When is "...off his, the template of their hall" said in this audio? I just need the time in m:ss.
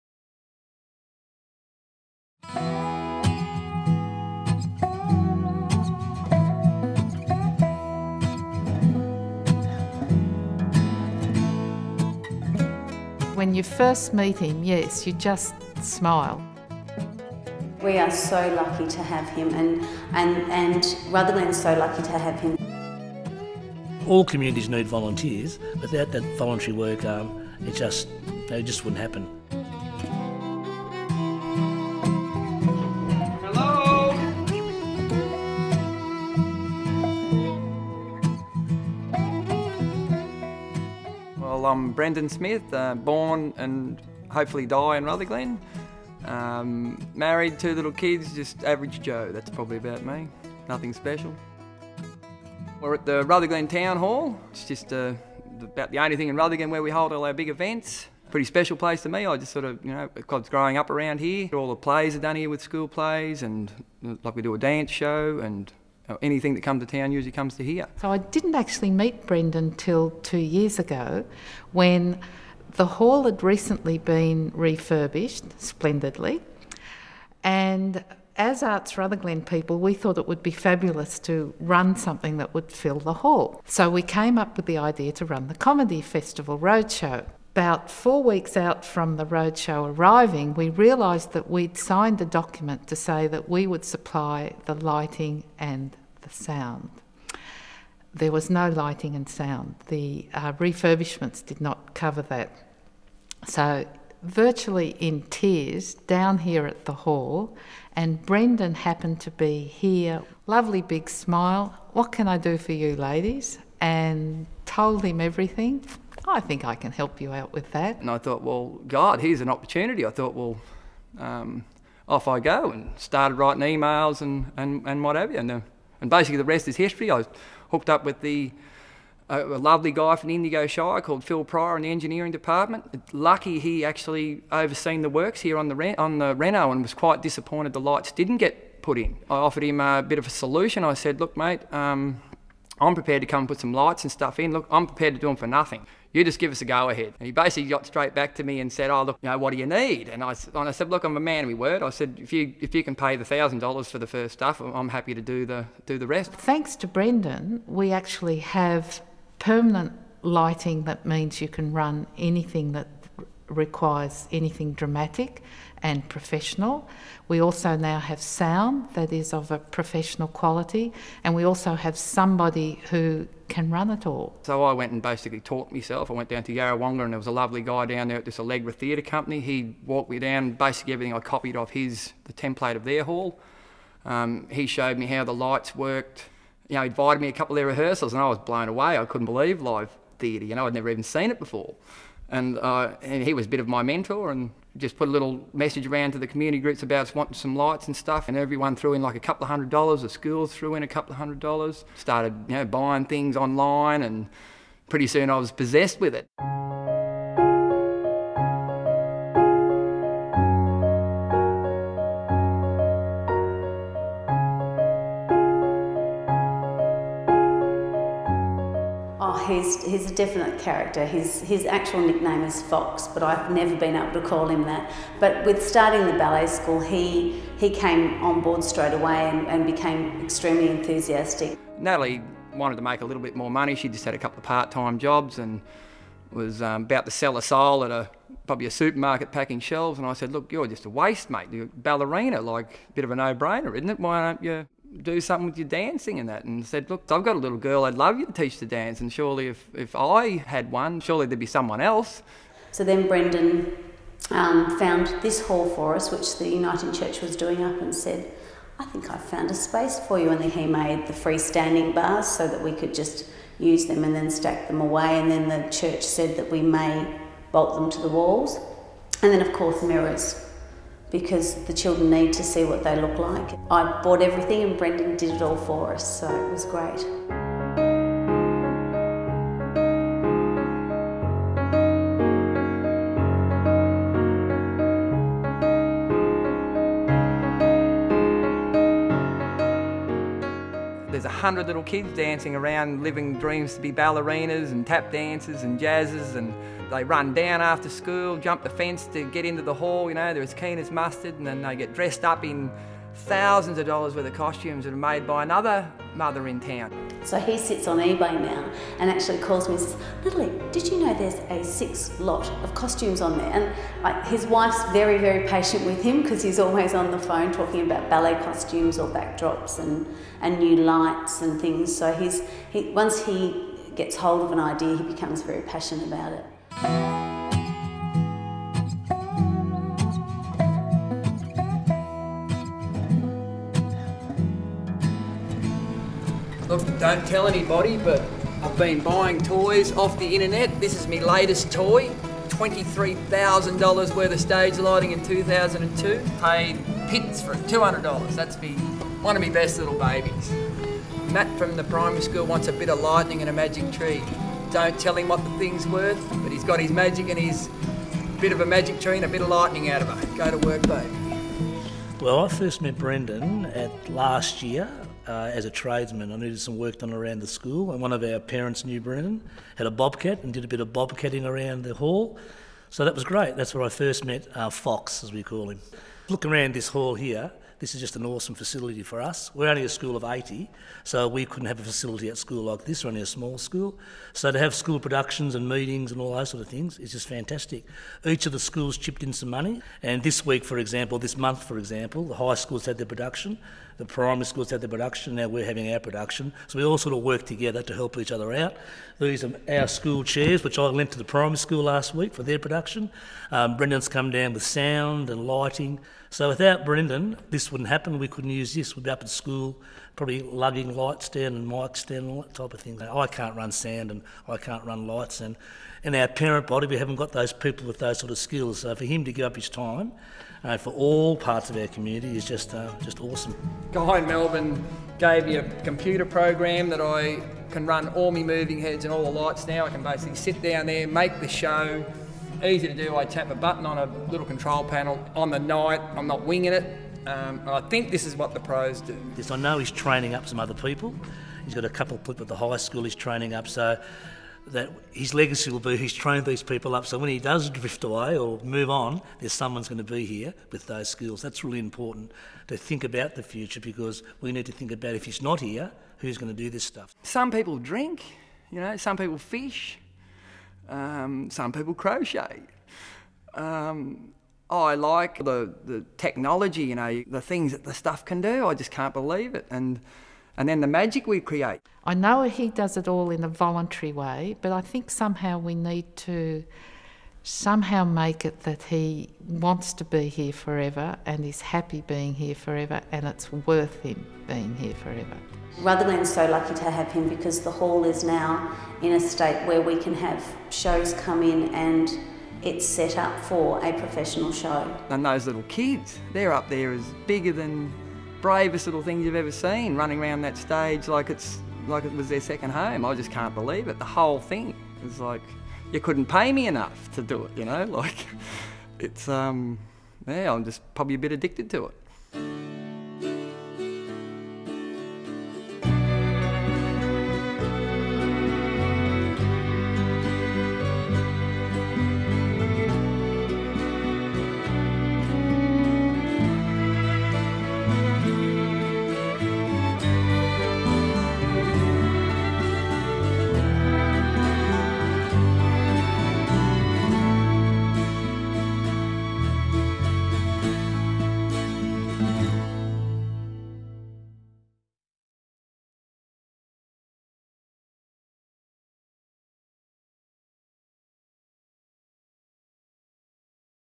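3:01.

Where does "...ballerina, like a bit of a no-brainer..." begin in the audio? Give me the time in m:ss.
4:01.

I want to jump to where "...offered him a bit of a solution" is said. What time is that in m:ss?
2:19.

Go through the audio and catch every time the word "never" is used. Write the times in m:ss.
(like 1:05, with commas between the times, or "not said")
3:10, 3:43.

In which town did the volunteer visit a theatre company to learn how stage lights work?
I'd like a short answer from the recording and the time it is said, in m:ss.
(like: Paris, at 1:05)
Yarrawonga, at 2:56.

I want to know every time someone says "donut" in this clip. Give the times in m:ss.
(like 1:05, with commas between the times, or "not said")
not said.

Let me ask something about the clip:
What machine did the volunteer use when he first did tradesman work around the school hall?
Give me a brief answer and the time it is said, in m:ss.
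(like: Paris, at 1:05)
bobcat, at 6:09.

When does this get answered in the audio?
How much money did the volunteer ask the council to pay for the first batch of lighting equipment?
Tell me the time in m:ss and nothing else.
2:33.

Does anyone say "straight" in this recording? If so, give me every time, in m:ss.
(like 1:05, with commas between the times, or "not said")
2:27, 3:48.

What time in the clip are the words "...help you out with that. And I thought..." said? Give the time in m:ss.
1:56.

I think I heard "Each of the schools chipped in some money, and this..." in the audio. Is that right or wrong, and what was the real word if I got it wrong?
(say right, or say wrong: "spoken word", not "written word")
right.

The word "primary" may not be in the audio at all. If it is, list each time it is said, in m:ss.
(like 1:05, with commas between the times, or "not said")
5:51, 6:34, 6:41.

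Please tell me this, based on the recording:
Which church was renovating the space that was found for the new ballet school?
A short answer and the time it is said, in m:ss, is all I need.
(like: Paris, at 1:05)
United church, at 4:16.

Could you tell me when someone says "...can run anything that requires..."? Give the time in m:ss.
2:41.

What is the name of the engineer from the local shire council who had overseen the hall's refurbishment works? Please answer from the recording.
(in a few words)
Phil Pryor.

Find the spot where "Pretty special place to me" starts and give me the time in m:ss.
0:58.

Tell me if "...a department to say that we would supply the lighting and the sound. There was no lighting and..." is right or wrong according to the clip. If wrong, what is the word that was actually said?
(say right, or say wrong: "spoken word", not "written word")
wrong: "document", not "department".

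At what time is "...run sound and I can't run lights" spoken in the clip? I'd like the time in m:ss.
6:53.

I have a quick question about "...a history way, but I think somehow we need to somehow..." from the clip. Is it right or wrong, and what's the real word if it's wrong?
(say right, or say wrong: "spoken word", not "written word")
wrong: "voluntary", not "history".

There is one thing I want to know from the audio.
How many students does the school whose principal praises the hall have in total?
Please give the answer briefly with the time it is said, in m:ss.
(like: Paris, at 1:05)
80, at 6:20.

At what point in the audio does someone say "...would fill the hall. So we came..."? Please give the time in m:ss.
1:22.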